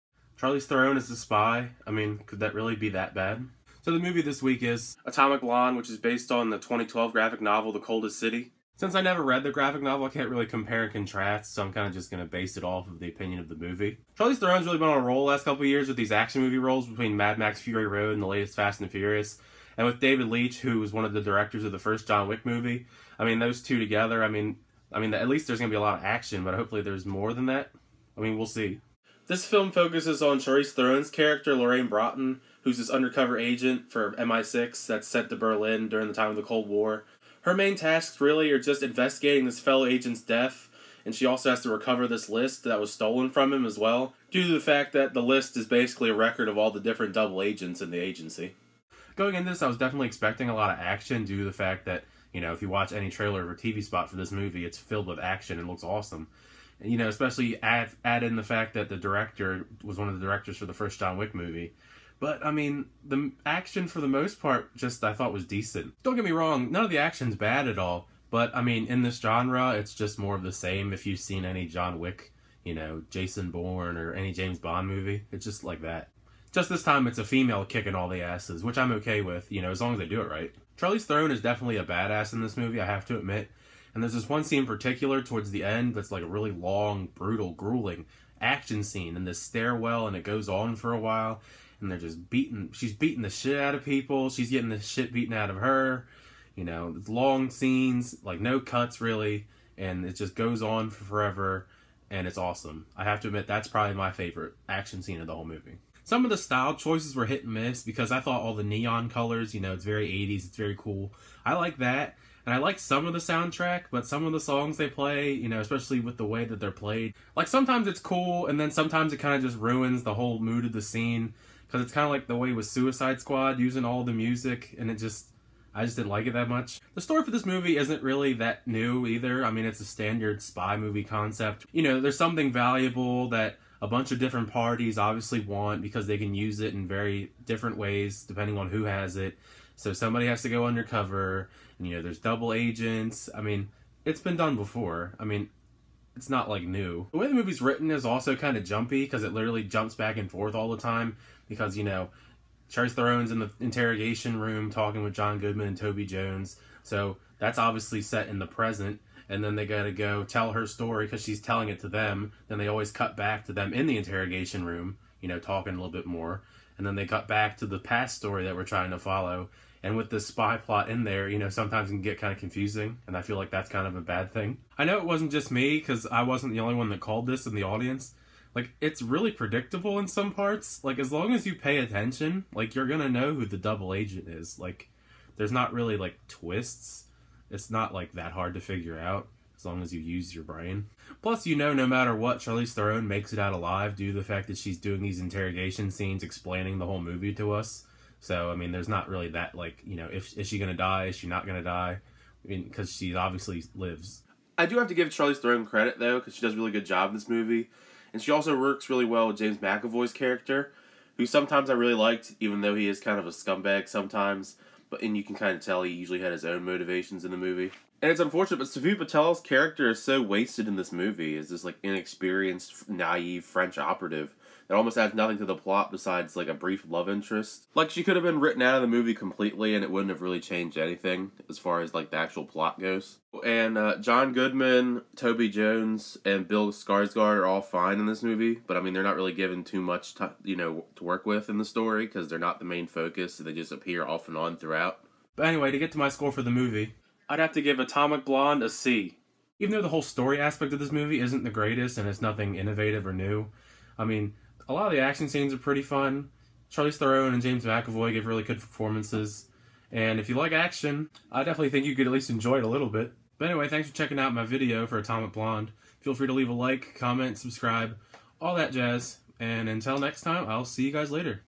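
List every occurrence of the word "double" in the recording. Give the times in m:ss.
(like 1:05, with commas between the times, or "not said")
0:47, 2:22, 3:03.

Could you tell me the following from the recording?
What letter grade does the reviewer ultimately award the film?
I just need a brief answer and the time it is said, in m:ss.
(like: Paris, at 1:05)
C, at 4:08.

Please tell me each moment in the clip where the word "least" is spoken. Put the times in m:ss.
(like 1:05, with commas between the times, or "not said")
0:25, 4:22.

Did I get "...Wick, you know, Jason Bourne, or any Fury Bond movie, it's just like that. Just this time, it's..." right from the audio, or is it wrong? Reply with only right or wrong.
wrong.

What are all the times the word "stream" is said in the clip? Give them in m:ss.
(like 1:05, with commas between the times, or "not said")
not said.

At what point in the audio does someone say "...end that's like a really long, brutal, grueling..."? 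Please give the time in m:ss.
1:25.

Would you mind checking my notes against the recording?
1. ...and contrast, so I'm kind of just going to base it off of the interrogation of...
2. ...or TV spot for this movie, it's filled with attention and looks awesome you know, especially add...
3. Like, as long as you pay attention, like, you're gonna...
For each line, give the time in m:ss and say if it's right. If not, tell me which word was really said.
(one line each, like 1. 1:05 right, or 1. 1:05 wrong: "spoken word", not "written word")
1. 0:10 wrong: "opinion", not "interrogation"
2. 0:53 wrong: "action", not "attention"
3. 3:00 right.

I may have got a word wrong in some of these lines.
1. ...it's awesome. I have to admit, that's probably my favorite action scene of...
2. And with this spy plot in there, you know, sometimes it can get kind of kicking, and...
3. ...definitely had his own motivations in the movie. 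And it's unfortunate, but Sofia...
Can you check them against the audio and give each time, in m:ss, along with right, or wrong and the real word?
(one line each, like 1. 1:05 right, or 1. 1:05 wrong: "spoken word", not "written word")
1. 1:42 right
2. 2:49 wrong: "confusing", not "kicking"
3. 3:35 wrong: "usually", not "definitely".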